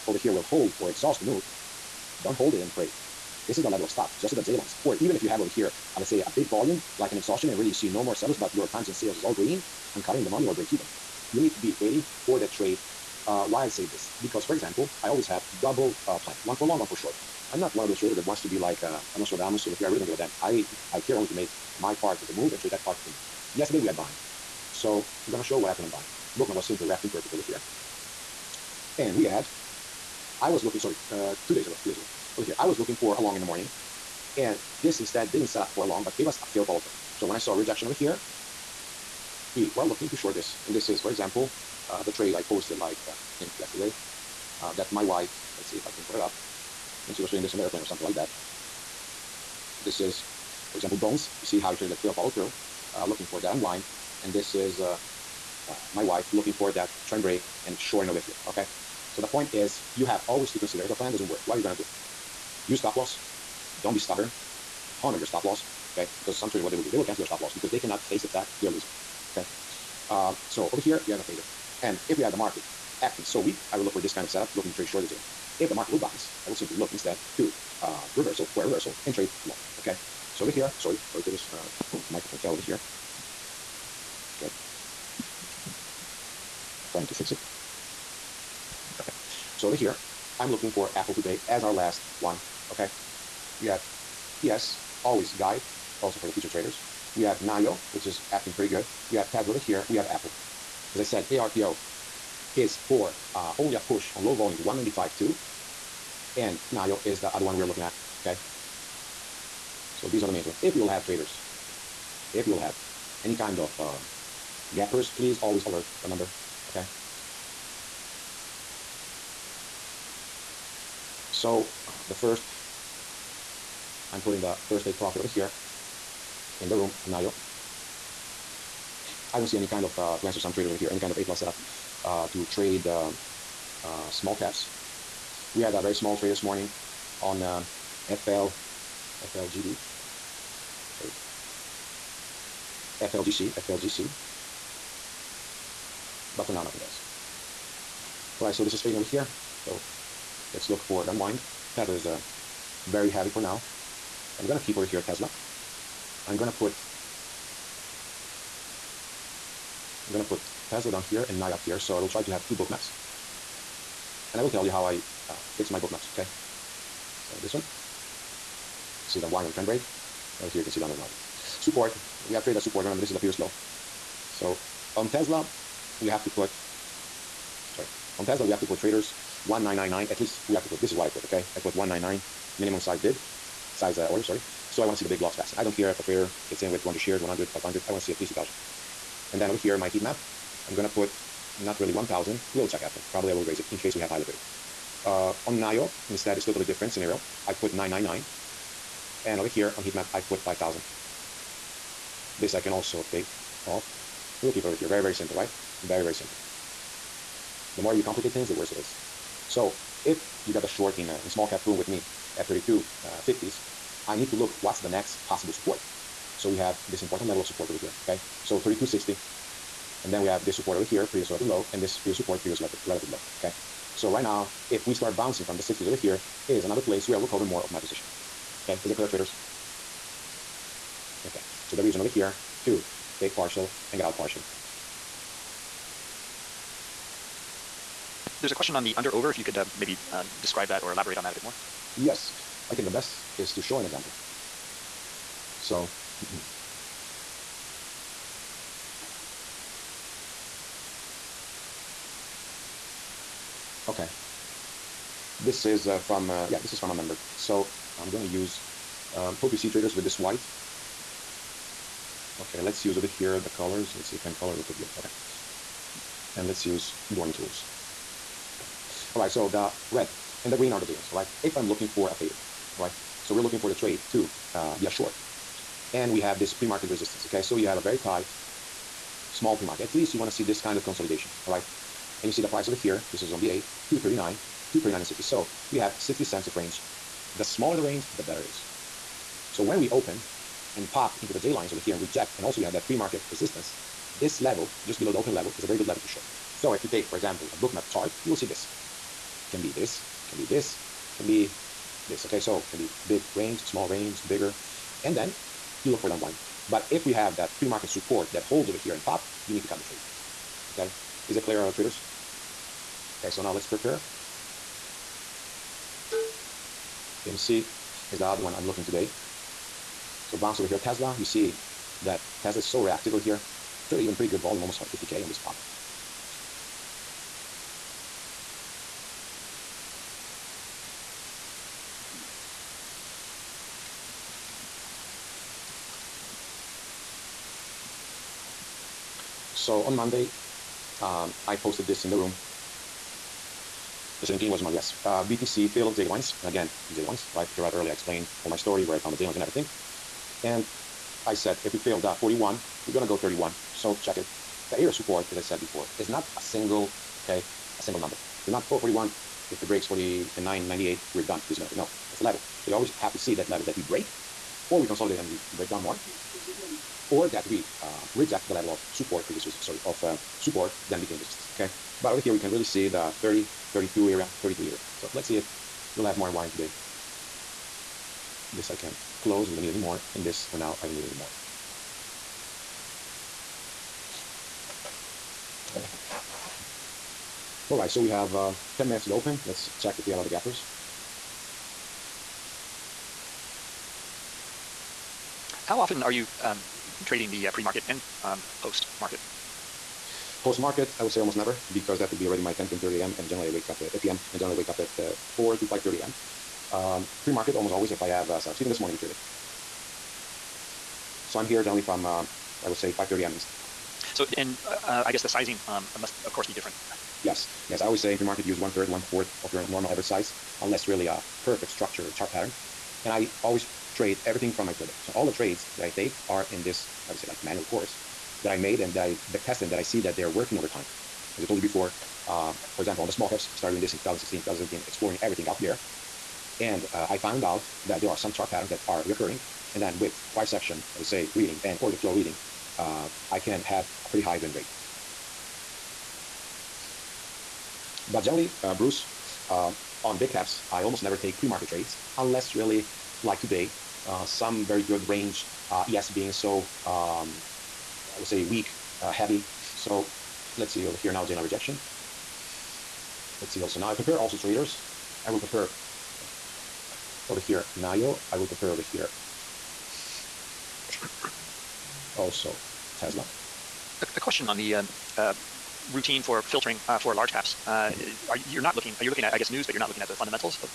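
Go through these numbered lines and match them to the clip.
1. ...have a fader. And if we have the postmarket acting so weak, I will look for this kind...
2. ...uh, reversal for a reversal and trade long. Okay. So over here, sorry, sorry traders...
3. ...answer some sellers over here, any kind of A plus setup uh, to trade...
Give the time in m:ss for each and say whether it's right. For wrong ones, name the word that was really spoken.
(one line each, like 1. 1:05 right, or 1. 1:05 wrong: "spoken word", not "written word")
1. 1:11 wrong: "market", not "postmarket"
2. 1:17 right
3. 2:10 wrong: "traders", not "sellers".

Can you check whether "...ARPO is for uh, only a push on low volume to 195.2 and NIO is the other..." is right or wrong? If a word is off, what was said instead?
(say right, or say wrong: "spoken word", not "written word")
right.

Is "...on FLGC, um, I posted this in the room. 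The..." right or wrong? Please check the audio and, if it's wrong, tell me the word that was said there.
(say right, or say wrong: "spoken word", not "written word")
wrong: "Monday", not "FLGC".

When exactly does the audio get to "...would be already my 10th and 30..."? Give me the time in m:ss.
6:42.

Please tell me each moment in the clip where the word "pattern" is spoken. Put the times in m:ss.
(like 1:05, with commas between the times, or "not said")
7:02, 7:18.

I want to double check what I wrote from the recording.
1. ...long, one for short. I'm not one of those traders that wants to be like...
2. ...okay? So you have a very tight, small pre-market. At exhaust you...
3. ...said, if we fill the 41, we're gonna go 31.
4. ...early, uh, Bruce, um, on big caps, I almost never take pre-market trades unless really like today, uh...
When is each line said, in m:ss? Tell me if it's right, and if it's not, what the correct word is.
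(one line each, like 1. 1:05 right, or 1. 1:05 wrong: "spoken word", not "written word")
1. 0:16 right
2. 4:37 wrong: "least", not "exhaust"
3. 5:51 right
4. 7:28 wrong: "generally", not "early".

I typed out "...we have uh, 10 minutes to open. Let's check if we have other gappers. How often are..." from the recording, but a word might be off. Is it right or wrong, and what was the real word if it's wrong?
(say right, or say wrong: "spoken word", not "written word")
right.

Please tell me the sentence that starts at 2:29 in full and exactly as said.
So let's look for the unwind.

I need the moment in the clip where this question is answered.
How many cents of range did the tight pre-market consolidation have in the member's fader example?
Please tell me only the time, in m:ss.
4:45.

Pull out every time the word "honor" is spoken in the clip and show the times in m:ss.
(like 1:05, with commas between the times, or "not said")
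1:05.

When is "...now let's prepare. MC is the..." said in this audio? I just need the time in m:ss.
5:13.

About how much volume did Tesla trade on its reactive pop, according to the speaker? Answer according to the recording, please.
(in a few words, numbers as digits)
50K.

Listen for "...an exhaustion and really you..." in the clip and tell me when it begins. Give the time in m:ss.
0:07.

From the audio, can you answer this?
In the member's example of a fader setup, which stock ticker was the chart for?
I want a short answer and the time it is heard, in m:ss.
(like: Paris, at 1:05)
BA, at 4:43.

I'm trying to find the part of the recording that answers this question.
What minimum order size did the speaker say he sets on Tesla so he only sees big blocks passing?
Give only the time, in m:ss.
3:01.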